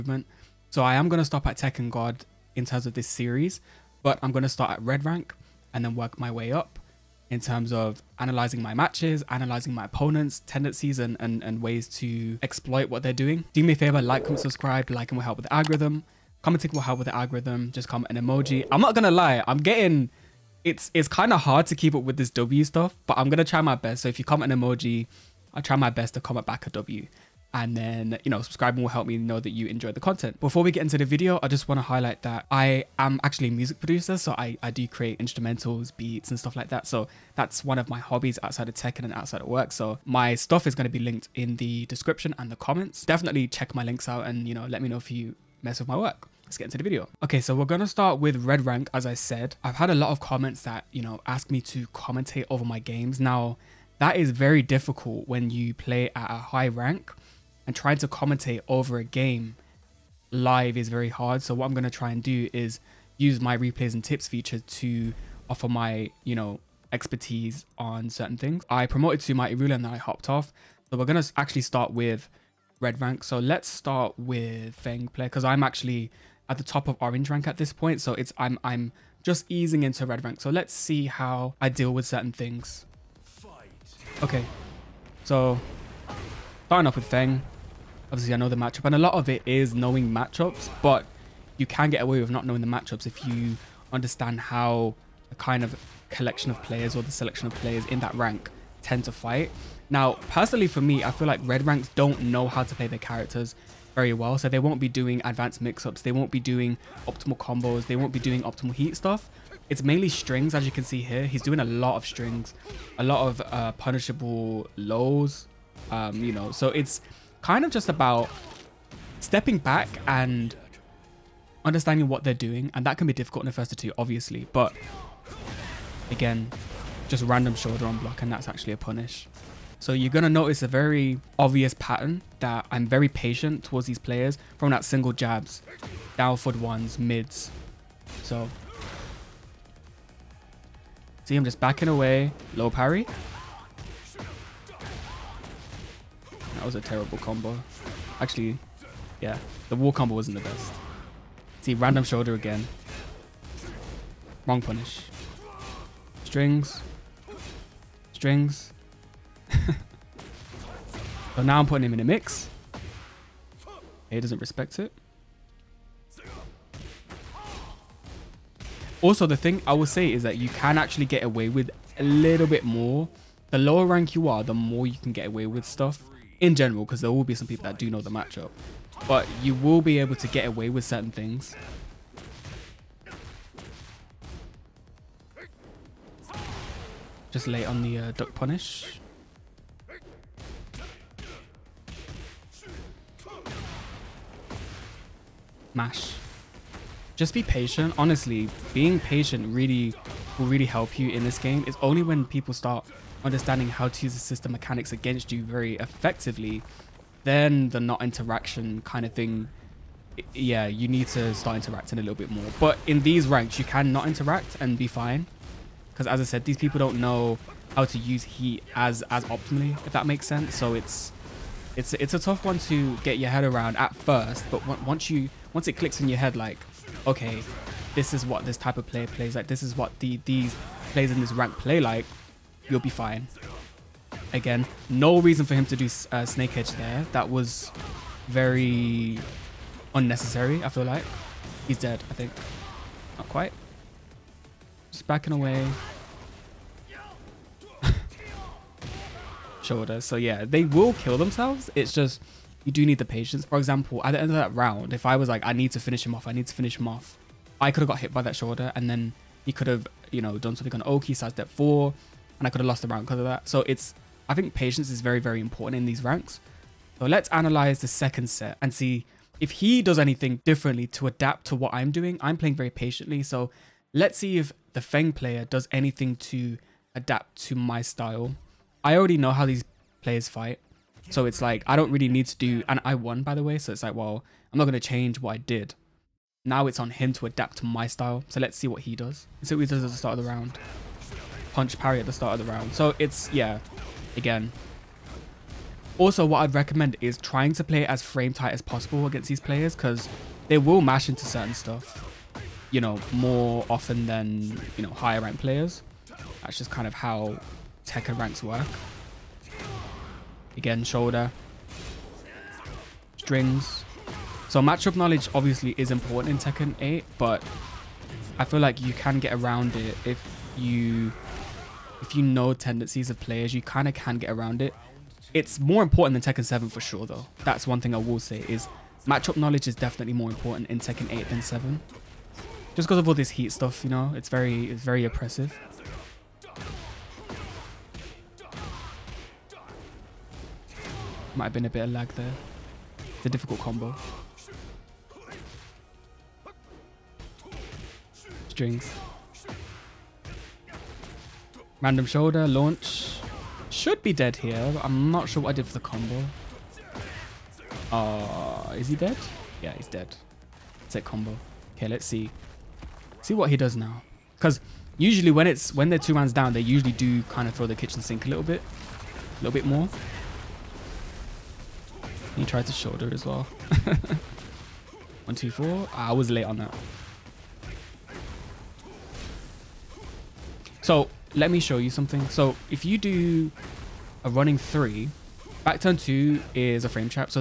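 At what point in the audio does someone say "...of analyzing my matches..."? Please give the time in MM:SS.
00:07.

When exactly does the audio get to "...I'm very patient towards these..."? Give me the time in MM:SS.
02:12.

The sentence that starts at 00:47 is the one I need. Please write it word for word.
Okay, so we're gonna start with Red Rank, as I said.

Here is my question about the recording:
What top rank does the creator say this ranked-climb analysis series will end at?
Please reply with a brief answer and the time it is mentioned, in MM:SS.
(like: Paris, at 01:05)
Tekken God, at 00:01.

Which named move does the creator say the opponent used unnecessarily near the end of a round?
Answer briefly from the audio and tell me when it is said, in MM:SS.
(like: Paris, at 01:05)
Snake Edge, at 03:56.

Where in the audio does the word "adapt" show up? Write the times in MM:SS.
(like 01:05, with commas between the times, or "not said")
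04:31, 04:36, 04:47.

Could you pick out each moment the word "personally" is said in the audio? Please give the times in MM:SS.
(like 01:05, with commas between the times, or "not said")
01:40.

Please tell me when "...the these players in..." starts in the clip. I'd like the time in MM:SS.
03:49.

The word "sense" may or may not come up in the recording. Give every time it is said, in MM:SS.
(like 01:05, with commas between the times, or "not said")
03:40.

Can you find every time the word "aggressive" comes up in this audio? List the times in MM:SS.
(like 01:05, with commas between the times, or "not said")
not said.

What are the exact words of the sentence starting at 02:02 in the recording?
And that can be difficult in the first to two, obviously.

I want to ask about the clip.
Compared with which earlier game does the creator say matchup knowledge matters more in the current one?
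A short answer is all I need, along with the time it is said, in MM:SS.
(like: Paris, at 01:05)
Tekken 7, at 05:26.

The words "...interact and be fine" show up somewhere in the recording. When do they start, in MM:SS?
03:34.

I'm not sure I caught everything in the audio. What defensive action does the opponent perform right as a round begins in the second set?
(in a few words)
punch parry.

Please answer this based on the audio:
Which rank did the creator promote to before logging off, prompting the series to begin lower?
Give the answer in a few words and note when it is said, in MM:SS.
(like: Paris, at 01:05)
Mighty Ruler, at 01:09.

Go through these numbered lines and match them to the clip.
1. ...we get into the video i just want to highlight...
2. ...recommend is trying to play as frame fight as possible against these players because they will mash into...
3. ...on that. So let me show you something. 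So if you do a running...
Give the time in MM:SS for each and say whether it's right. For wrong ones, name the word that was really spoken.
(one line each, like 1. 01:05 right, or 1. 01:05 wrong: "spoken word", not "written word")
1. 00:30 right
2. 04:56 wrong: "tight", not "fight"
3. 06:16 right.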